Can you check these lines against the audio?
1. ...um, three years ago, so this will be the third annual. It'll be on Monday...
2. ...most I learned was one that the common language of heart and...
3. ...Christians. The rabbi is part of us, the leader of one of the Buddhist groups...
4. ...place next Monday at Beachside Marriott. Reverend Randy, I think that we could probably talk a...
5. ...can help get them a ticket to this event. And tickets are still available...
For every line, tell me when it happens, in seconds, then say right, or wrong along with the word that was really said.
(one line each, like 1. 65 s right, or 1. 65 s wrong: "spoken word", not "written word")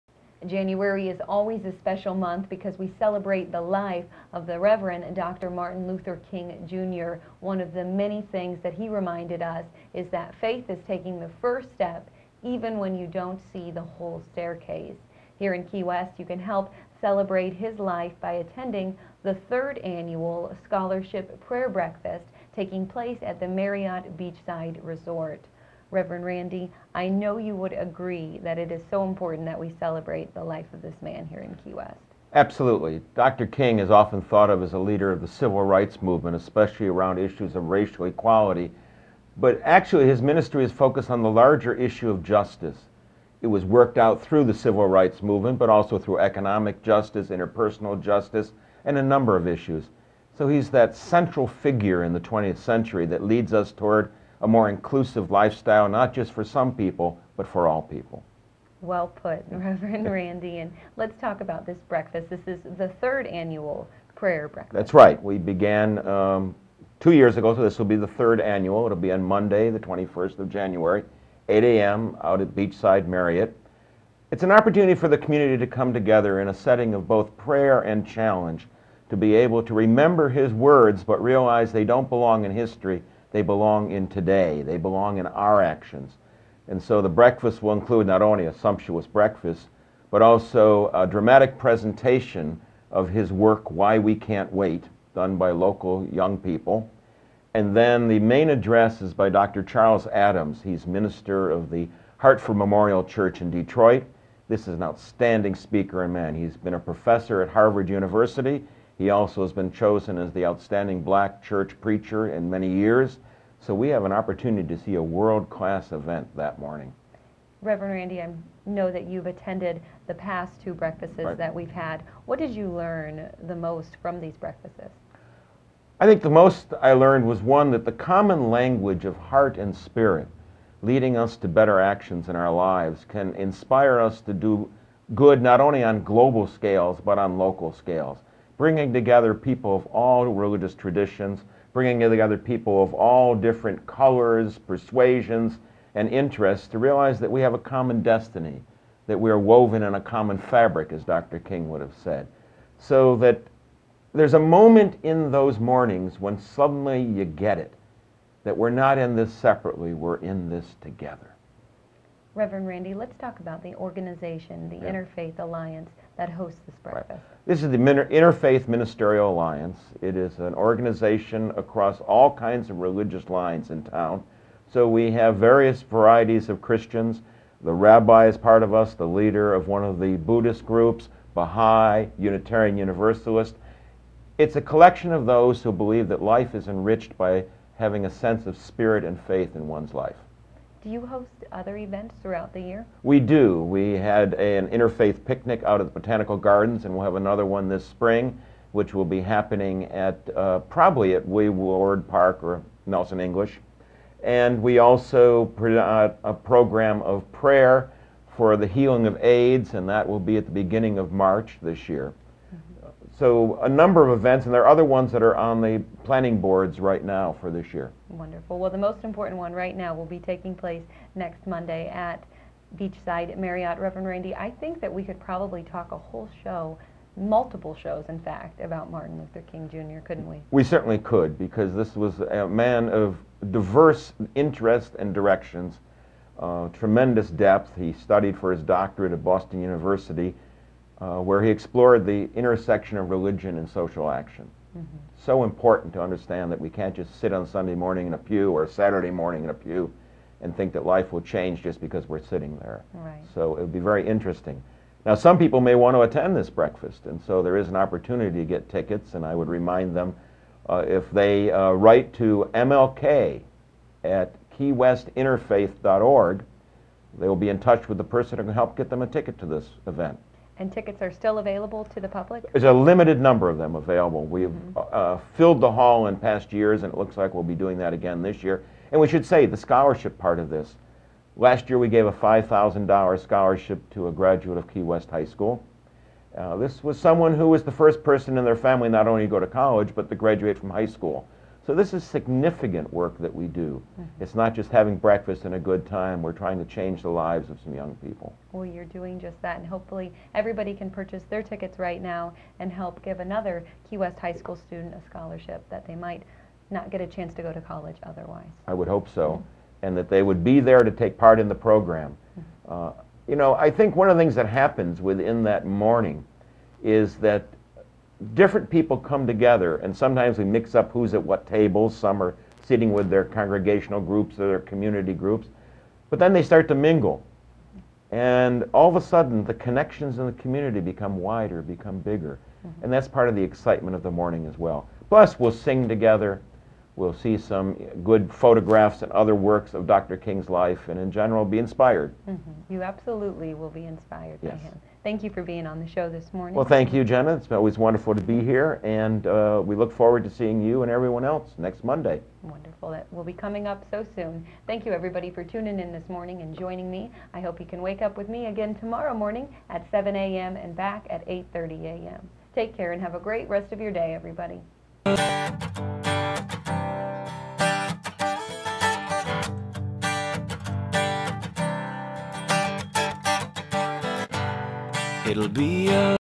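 1. 66 s wrong: "two", not "three"
2. 126 s right
3. 176 s right
4. 220 s right
5. 268 s right.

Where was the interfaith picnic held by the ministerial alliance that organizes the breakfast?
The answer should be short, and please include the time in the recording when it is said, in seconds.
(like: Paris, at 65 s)
Botanical Gardens, at 195 s.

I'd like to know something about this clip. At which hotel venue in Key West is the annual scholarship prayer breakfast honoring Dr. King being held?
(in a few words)
Marriott Beachside Resort.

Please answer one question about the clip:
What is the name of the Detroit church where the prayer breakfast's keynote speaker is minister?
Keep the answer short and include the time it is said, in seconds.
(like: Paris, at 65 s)
Hartford Memorial Church, at 102 s.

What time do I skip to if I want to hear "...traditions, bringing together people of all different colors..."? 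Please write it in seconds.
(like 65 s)
140 s.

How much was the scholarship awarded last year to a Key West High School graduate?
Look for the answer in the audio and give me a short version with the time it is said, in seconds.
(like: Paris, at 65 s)
$5,000, at 282 s.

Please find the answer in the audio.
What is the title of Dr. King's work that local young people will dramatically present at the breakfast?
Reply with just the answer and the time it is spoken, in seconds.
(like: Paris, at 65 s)
Why We Can't Wait, at 93 s.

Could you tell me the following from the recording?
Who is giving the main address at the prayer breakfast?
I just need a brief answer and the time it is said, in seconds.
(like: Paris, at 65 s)
Dr. Charles Adams, at 99 s.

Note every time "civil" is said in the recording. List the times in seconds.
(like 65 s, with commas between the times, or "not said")
35 s, 44 s.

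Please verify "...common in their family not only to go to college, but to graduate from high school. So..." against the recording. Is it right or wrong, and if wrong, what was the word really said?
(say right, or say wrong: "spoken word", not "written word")
wrong: "person", not "common".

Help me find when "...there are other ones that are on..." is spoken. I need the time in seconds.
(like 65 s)
214 s.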